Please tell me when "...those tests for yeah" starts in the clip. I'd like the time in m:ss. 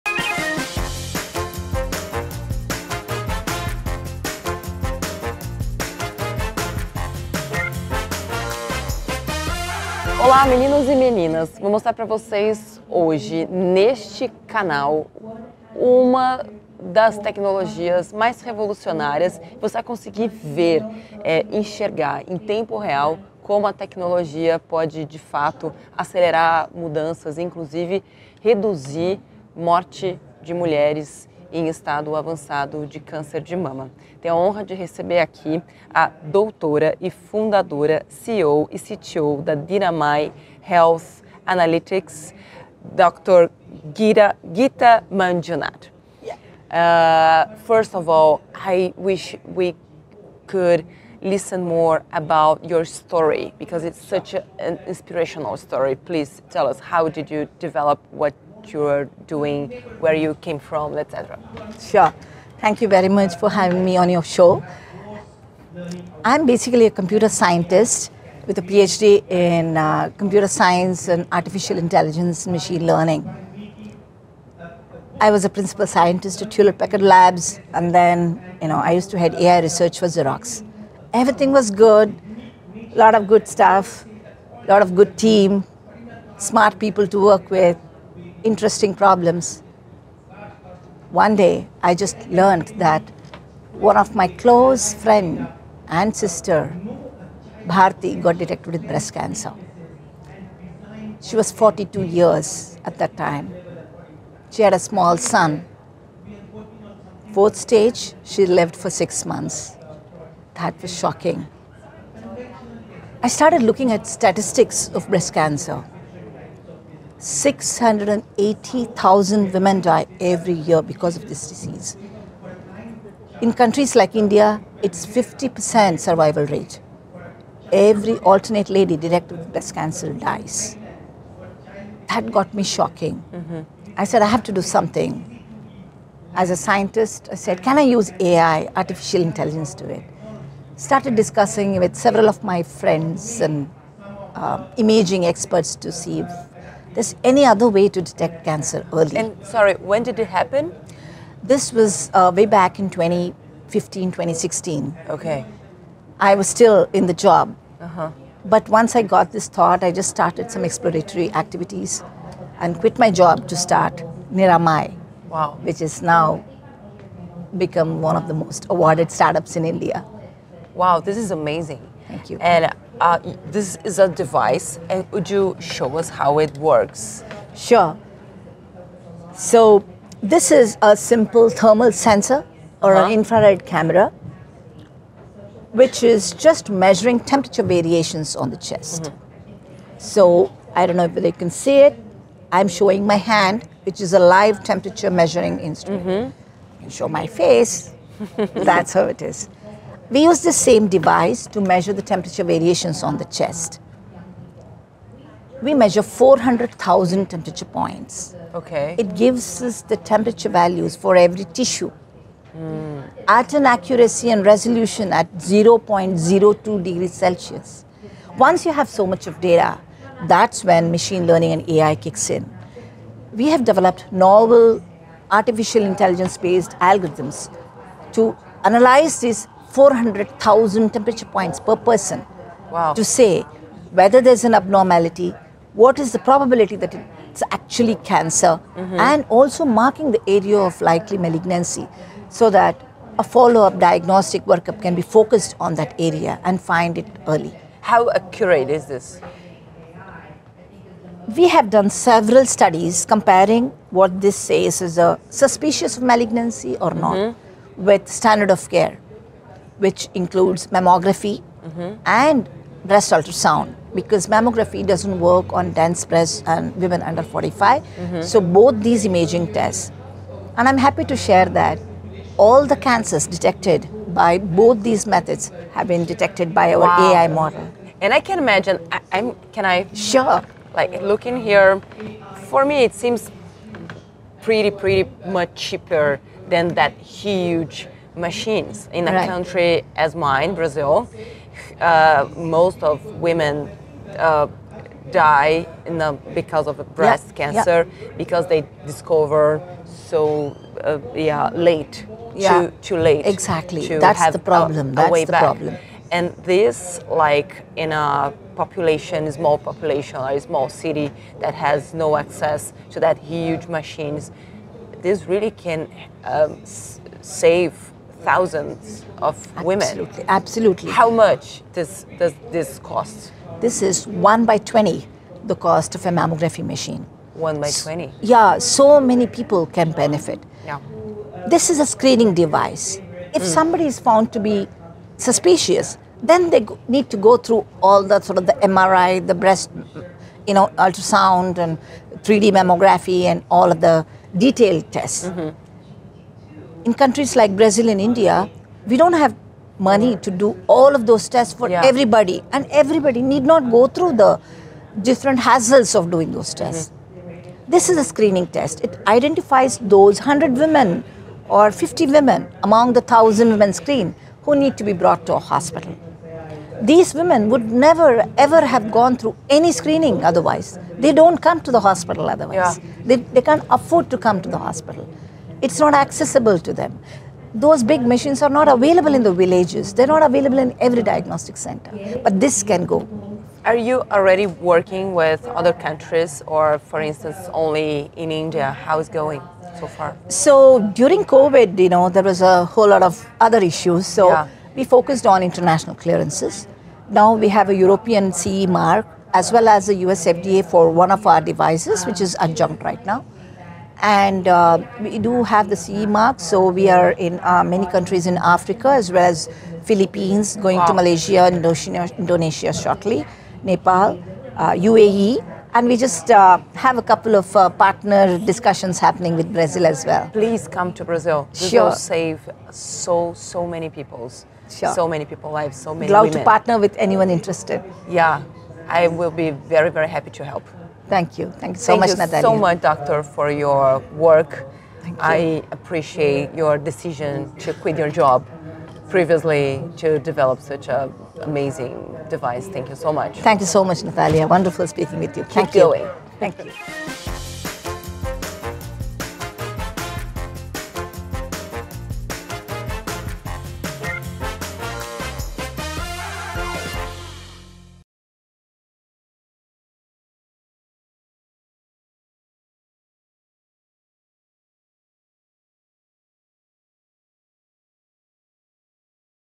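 5:51.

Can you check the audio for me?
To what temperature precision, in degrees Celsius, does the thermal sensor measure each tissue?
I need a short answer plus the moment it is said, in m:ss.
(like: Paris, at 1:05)
0.02 degrees Celsius, at 3:35.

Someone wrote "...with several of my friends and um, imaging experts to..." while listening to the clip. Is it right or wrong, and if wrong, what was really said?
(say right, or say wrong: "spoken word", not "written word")
right.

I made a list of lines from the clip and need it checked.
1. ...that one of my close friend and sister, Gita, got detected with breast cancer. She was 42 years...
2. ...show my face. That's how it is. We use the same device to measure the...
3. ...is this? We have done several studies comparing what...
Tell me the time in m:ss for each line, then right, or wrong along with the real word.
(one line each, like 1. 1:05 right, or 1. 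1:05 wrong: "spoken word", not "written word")
1. 1:32 wrong: "Bharti", not "Gita"
2. 3:16 right
3. 4:08 right.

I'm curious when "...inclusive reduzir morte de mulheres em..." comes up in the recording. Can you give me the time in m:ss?
0:27.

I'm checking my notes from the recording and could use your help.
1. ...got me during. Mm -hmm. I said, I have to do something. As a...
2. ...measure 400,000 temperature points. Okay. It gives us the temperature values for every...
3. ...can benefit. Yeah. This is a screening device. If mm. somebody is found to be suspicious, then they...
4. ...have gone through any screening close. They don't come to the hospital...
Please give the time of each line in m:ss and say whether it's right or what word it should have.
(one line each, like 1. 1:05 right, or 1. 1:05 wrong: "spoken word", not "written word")
1. 2:12 wrong: "shocking", not "during"
2. 3:25 right
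3. 5:29 right
4. 6:08 wrong: "otherwise", not "close".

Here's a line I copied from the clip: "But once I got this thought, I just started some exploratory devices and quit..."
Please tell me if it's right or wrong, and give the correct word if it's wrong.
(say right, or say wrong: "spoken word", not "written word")
wrong: "activities", not "devices".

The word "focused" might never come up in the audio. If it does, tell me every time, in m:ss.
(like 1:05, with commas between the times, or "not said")
4:05, 6:34.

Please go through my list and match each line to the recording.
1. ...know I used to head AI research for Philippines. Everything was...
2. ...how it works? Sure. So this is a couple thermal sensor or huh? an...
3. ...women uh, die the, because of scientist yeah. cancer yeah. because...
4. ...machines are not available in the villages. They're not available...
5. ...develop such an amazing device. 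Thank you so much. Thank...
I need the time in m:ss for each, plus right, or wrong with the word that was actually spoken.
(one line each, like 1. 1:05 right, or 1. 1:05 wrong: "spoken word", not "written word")
1. 1:18 wrong: "Xerox", not "Philippines"
2. 2:56 wrong: "simple", not "couple"
3. 4:53 wrong: "breast", not "scientist"
4. 6:18 right
5. 7:20 right.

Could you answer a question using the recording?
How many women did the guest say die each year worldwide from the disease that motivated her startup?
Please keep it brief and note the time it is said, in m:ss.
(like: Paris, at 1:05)
680,000, at 1:57.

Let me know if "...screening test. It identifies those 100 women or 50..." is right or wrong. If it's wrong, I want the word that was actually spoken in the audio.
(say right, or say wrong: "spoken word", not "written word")
right.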